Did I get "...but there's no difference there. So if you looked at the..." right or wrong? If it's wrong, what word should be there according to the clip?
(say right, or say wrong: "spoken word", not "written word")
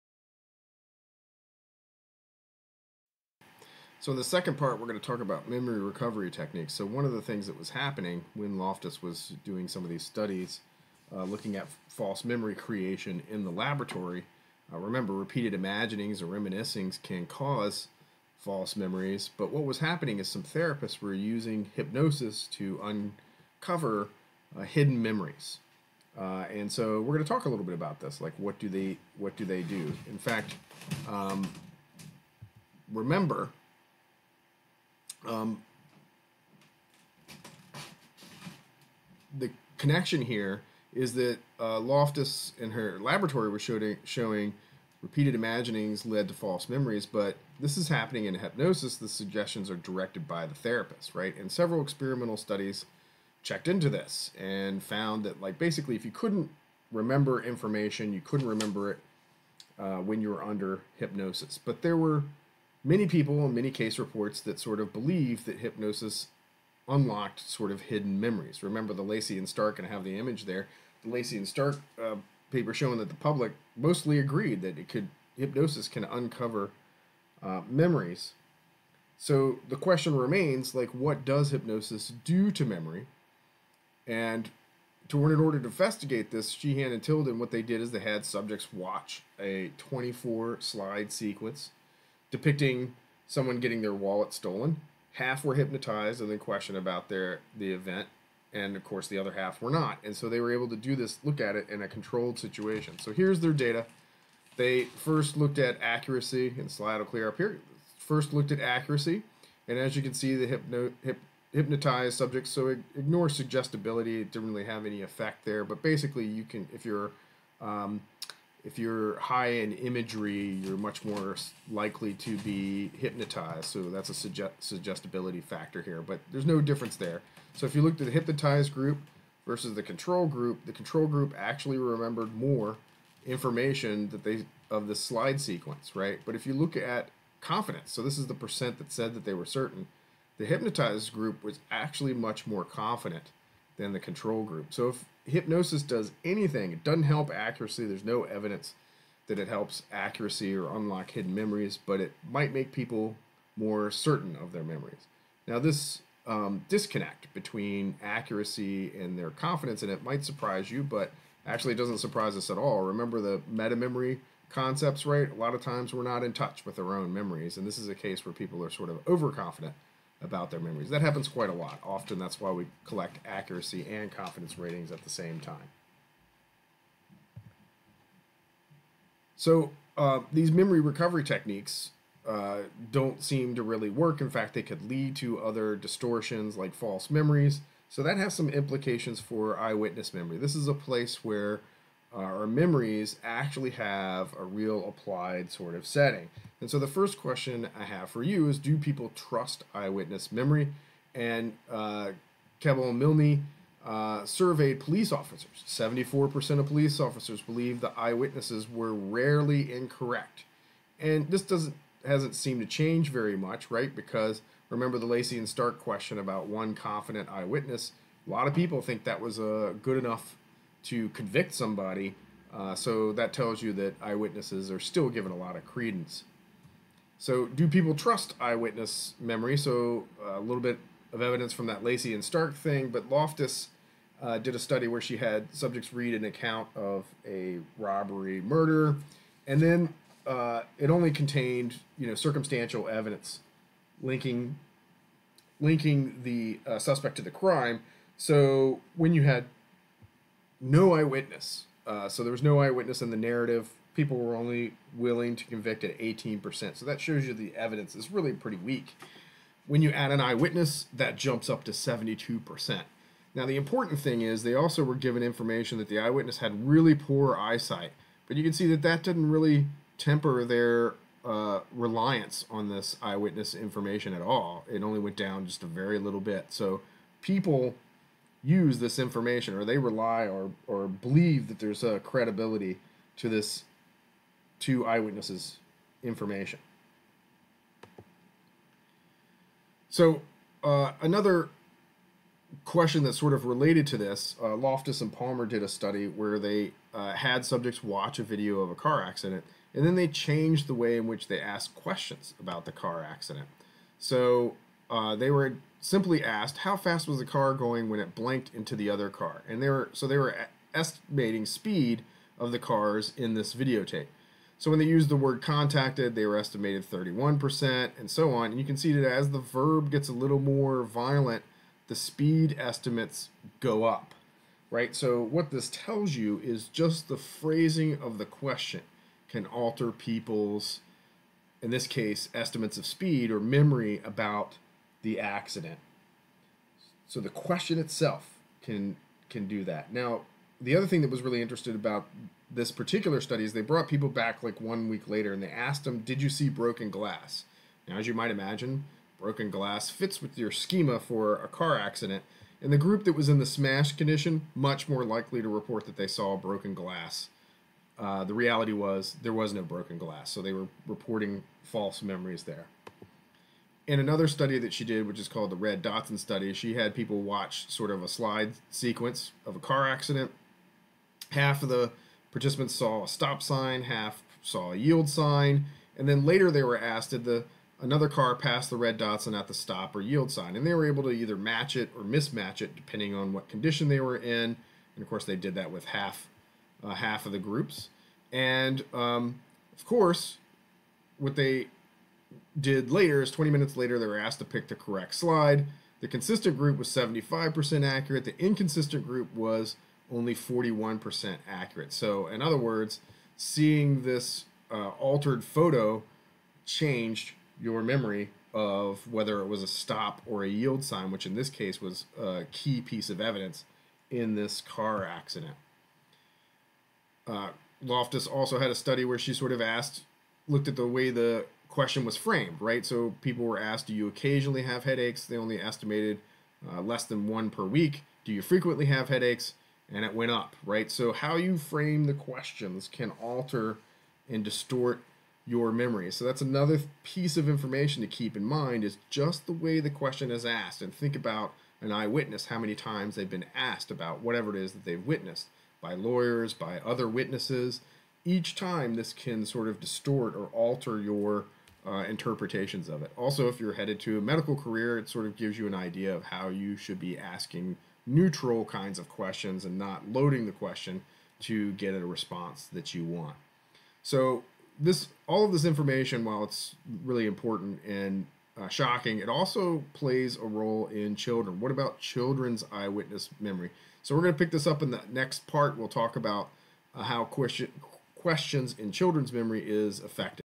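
right.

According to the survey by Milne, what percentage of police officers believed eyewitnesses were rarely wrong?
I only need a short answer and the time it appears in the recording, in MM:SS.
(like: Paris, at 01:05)
74%, at 03:25.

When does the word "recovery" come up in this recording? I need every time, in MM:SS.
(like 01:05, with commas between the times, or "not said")
00:05, 03:00.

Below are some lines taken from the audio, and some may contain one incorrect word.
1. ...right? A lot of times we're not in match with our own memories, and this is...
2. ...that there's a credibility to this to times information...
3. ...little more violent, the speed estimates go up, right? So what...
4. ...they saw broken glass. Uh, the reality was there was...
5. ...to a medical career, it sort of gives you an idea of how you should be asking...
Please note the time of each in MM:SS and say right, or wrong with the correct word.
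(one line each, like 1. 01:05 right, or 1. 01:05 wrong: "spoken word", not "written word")
1. 02:45 wrong: "touch", not "match"
2. 04:41 wrong: "eyewitnesses", not "times"
3. 05:20 right
4. 05:55 right
5. 07:34 right.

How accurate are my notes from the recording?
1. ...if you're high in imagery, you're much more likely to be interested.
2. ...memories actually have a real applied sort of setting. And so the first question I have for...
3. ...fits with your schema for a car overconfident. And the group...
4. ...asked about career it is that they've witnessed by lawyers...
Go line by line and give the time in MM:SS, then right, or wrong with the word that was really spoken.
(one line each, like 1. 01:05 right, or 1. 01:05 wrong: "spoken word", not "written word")
1. 01:58 wrong: "hypnotized", not "interested"
2. 03:12 right
3. 05:49 wrong: "accident", not "overconfident"
4. 07:23 wrong: "whatever", not "career".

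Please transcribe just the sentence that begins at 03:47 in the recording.
So, do people trust eyewitness memory?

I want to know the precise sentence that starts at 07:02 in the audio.
So people were asked, do you occasionally have headaches?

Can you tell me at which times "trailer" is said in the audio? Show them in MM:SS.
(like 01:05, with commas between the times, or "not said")
not said.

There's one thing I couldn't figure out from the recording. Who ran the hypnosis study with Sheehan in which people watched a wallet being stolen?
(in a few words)
Tilden.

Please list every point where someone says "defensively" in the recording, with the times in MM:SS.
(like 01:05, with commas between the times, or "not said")
not said.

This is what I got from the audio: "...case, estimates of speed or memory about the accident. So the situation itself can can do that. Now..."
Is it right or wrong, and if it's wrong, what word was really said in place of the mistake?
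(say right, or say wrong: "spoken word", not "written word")
wrong: "question", not "situation".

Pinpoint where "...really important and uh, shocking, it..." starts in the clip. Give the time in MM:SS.
07:47.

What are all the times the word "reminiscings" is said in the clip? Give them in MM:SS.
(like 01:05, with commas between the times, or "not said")
00:16.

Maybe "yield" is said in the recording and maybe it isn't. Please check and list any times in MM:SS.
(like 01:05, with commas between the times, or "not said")
06:14, 06:20, 06:50.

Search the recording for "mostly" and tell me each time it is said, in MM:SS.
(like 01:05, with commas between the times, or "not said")
01:13.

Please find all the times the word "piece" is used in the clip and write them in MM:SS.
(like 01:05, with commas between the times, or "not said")
06:52, 07:17.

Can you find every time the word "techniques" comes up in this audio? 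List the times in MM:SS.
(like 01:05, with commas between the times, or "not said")
00:06, 03:01.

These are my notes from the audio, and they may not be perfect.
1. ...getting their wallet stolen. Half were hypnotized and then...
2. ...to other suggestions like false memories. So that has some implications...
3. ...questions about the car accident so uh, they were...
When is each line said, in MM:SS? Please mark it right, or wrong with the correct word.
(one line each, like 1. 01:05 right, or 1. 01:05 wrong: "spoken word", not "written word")
1. 01:33 right
2. 03:05 wrong: "distortions", not "suggestions"
3. 05:01 right.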